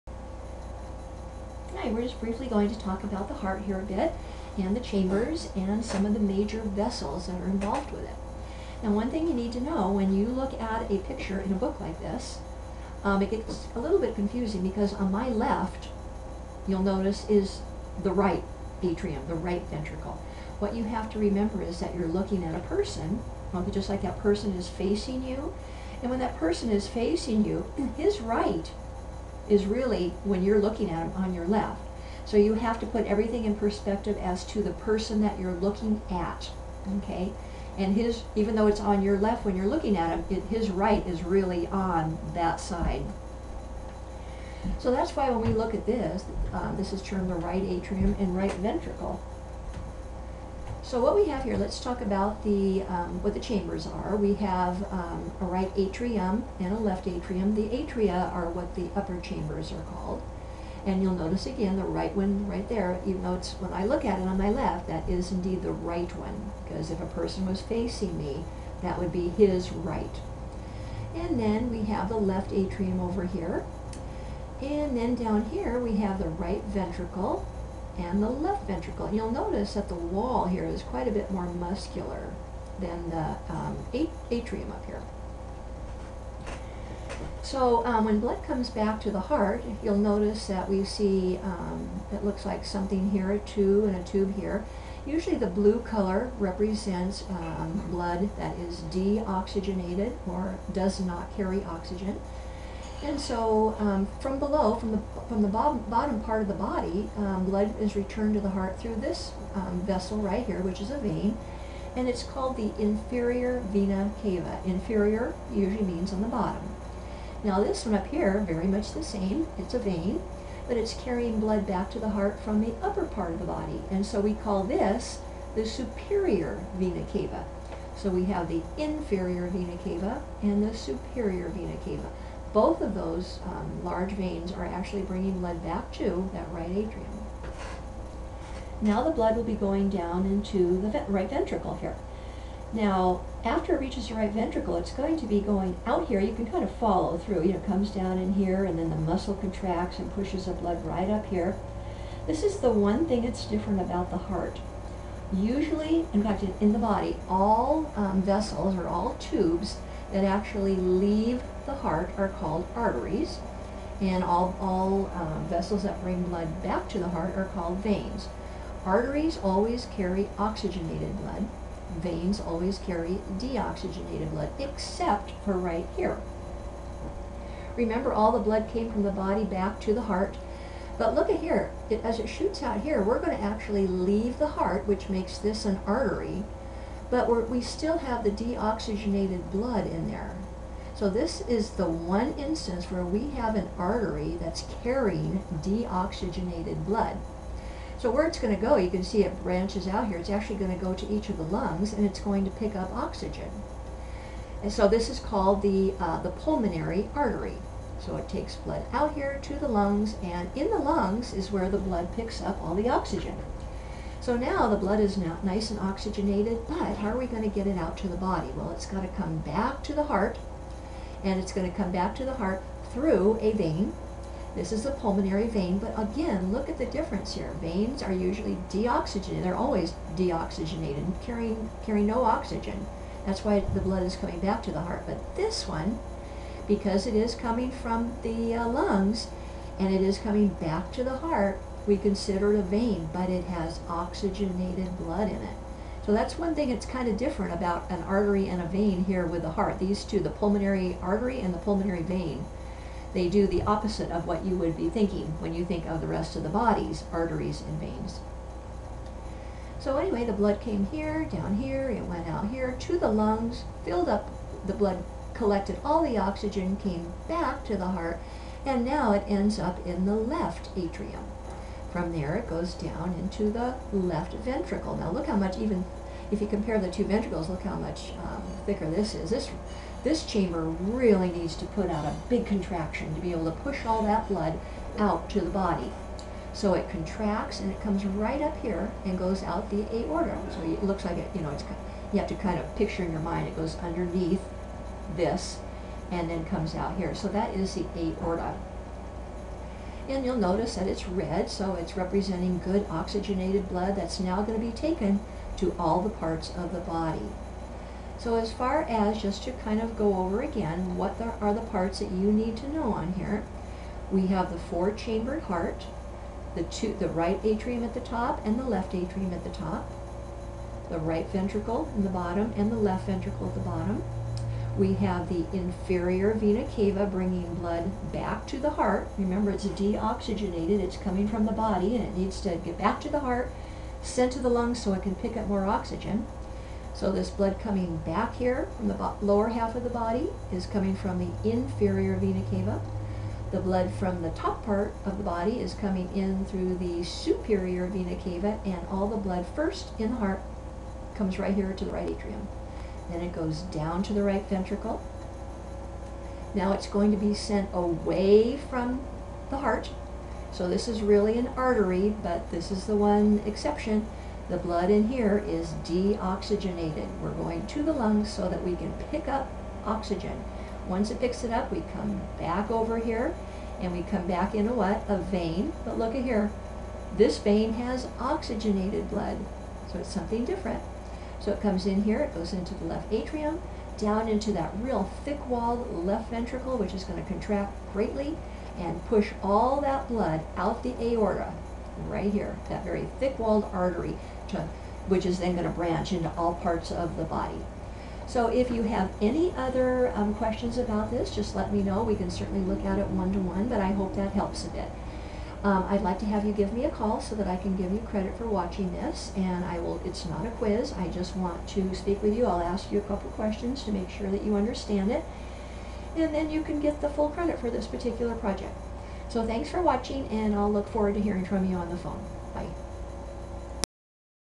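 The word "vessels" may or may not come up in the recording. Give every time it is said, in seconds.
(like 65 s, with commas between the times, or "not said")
6 s, 109 s, 158 s, 165 s.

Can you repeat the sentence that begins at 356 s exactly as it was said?
Now it's going to be sent away from the heart.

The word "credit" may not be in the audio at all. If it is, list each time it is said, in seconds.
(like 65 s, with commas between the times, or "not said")
407 s, 417 s.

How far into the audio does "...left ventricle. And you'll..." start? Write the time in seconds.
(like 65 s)
78 s.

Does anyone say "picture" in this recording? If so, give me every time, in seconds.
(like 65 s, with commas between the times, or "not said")
10 s, 292 s.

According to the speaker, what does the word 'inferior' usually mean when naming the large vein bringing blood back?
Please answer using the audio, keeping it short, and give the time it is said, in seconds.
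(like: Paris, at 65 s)
On the bottom, at 116 s.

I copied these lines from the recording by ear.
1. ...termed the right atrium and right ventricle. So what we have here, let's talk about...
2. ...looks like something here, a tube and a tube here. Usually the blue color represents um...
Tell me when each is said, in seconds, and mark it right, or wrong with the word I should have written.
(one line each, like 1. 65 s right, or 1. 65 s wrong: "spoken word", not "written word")
1. 47 s right
2. 92 s right.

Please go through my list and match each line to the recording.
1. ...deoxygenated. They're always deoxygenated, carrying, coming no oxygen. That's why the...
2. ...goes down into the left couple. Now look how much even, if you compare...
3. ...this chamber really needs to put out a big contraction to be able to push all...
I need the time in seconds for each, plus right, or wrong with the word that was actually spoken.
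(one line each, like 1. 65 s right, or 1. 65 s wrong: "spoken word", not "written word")
1. 228 s wrong: "carrying", not "coming"
2. 272 s wrong: "ventricle", not "couple"
3. 280 s right.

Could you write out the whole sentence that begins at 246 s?
So that's one thing that's kind of different about an artery and a vein here with the heart.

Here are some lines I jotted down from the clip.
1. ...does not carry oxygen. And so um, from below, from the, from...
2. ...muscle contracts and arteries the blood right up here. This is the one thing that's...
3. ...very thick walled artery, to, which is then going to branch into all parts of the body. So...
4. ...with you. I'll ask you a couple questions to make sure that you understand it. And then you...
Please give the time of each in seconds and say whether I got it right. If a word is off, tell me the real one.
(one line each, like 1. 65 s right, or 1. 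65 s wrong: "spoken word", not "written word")
1. 100 s right
2. 148 s wrong: "pushes", not "arteries"
3. 392 s right
4. 412 s right.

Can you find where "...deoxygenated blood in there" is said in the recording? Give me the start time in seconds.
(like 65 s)
188 s.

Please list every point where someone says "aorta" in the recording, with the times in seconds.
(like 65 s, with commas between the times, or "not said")
289 s, 297 s, 391 s.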